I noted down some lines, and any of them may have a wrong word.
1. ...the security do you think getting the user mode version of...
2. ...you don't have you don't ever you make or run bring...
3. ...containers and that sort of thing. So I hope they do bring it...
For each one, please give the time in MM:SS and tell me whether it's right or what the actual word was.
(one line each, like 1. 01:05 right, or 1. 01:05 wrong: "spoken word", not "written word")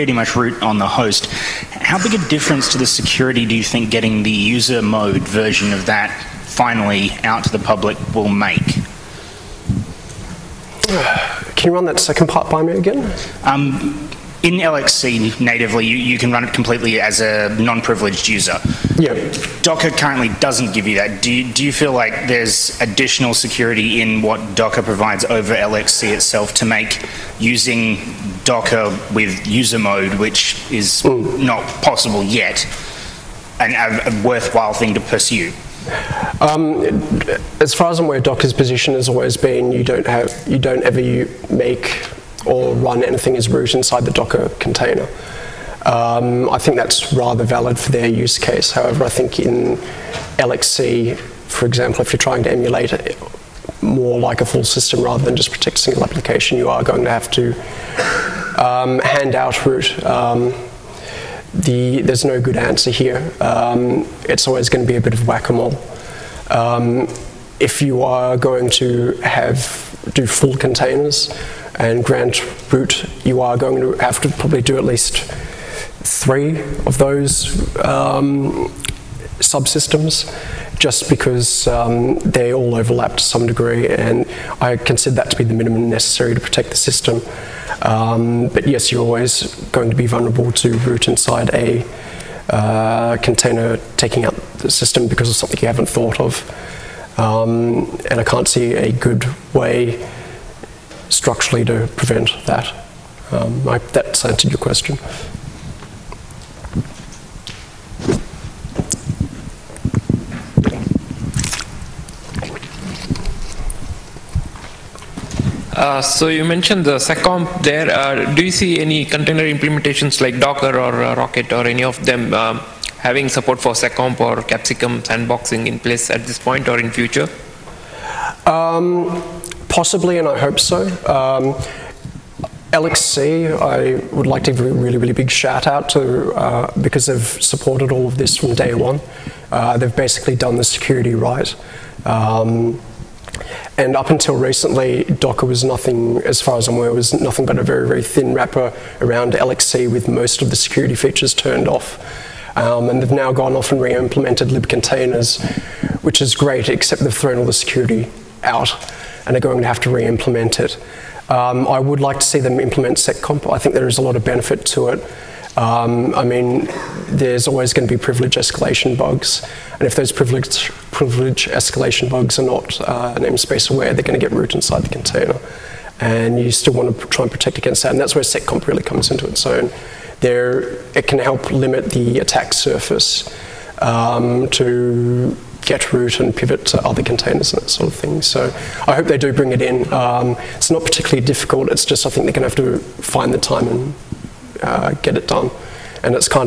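1. 00:02 right
2. 00:39 wrong: "anything", not "bring"
3. 03:07 right.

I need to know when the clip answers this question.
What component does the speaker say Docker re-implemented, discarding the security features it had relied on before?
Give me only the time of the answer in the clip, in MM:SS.
02:34.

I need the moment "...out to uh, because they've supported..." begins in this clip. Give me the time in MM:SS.
02:15.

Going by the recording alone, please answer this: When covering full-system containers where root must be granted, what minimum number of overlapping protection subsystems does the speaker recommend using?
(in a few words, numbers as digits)
3.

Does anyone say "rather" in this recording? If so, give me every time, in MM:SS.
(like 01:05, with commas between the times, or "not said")
00:47, 00:55.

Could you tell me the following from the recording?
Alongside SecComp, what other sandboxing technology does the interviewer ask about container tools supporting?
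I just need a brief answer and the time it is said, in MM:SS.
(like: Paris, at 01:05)
Capsicum, at 02:04.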